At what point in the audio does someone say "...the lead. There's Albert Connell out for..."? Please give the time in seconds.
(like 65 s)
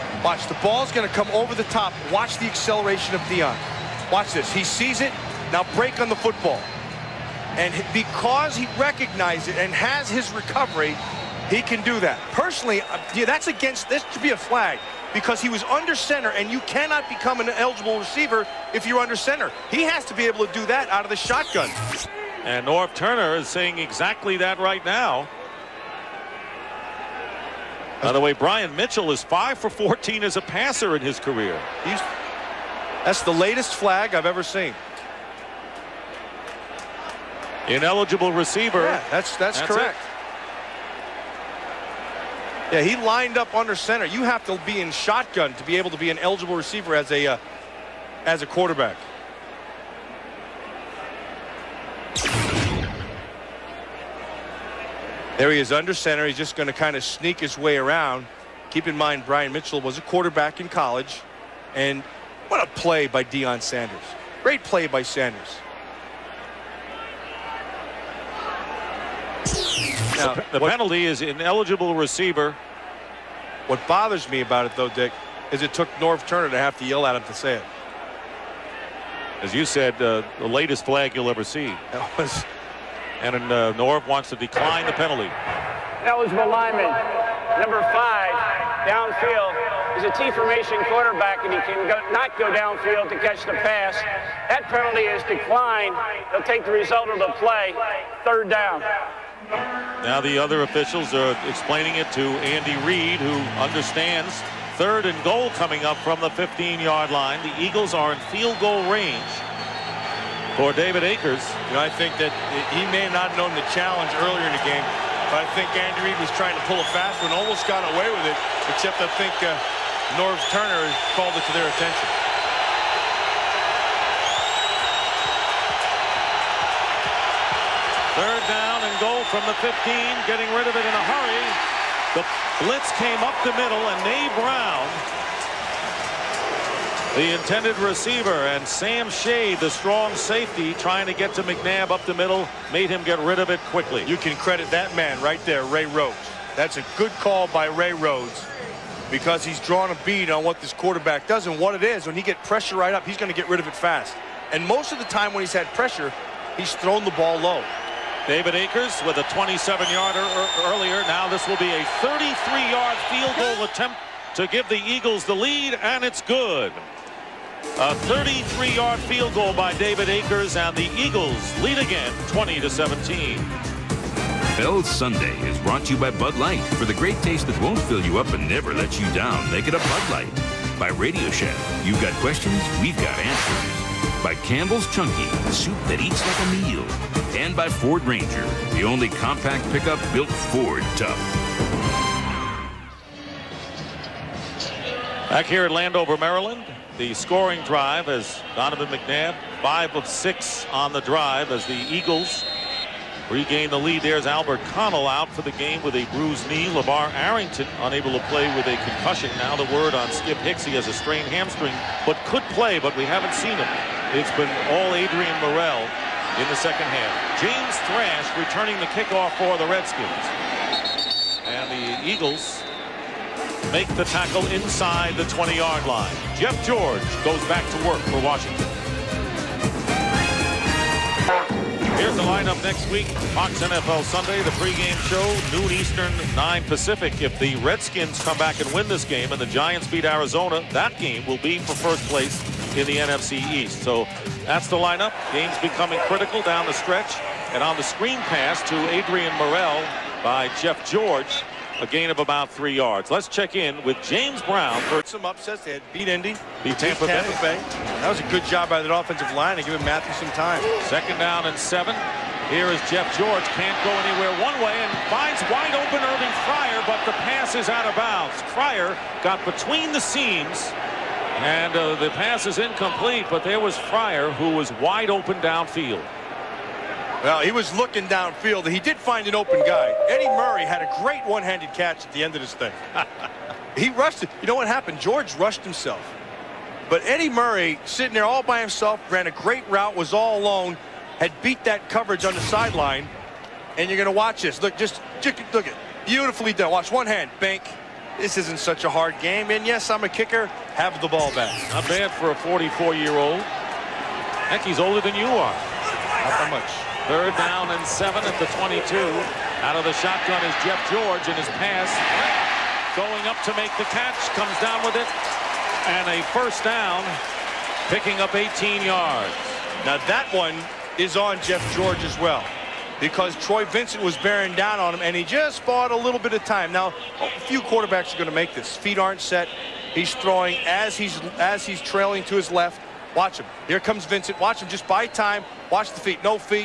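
203 s.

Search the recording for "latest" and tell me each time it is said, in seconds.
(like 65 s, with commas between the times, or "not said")
33 s, 80 s.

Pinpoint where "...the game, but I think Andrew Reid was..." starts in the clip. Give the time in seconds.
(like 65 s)
114 s.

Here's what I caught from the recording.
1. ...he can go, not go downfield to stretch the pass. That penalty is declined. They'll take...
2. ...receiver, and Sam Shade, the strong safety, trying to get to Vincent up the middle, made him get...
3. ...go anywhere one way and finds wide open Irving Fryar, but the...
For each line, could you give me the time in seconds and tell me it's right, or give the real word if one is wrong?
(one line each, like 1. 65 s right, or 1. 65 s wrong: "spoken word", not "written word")
1. 91 s wrong: "catch", not "stretch"
2. 137 s wrong: "McNabb", not "Vincent"
3. 263 s right.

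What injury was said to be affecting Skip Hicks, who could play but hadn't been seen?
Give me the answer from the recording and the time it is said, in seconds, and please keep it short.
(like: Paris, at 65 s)
strained hamstring, at 210 s.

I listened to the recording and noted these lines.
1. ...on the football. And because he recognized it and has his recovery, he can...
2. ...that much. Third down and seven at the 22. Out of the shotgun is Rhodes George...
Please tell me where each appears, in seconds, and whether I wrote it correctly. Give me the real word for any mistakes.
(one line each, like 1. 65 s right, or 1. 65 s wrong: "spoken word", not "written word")
1. 6 s right
2. 306 s wrong: "Jeff", not "Rhodes".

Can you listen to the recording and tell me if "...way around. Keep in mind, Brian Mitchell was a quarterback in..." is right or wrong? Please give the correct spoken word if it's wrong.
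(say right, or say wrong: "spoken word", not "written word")
right.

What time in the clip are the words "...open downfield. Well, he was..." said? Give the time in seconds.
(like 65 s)
275 s.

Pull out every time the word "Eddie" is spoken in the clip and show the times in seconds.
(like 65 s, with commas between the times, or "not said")
280 s, 287 s.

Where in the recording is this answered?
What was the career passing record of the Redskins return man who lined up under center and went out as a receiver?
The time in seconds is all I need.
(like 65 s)
29 s.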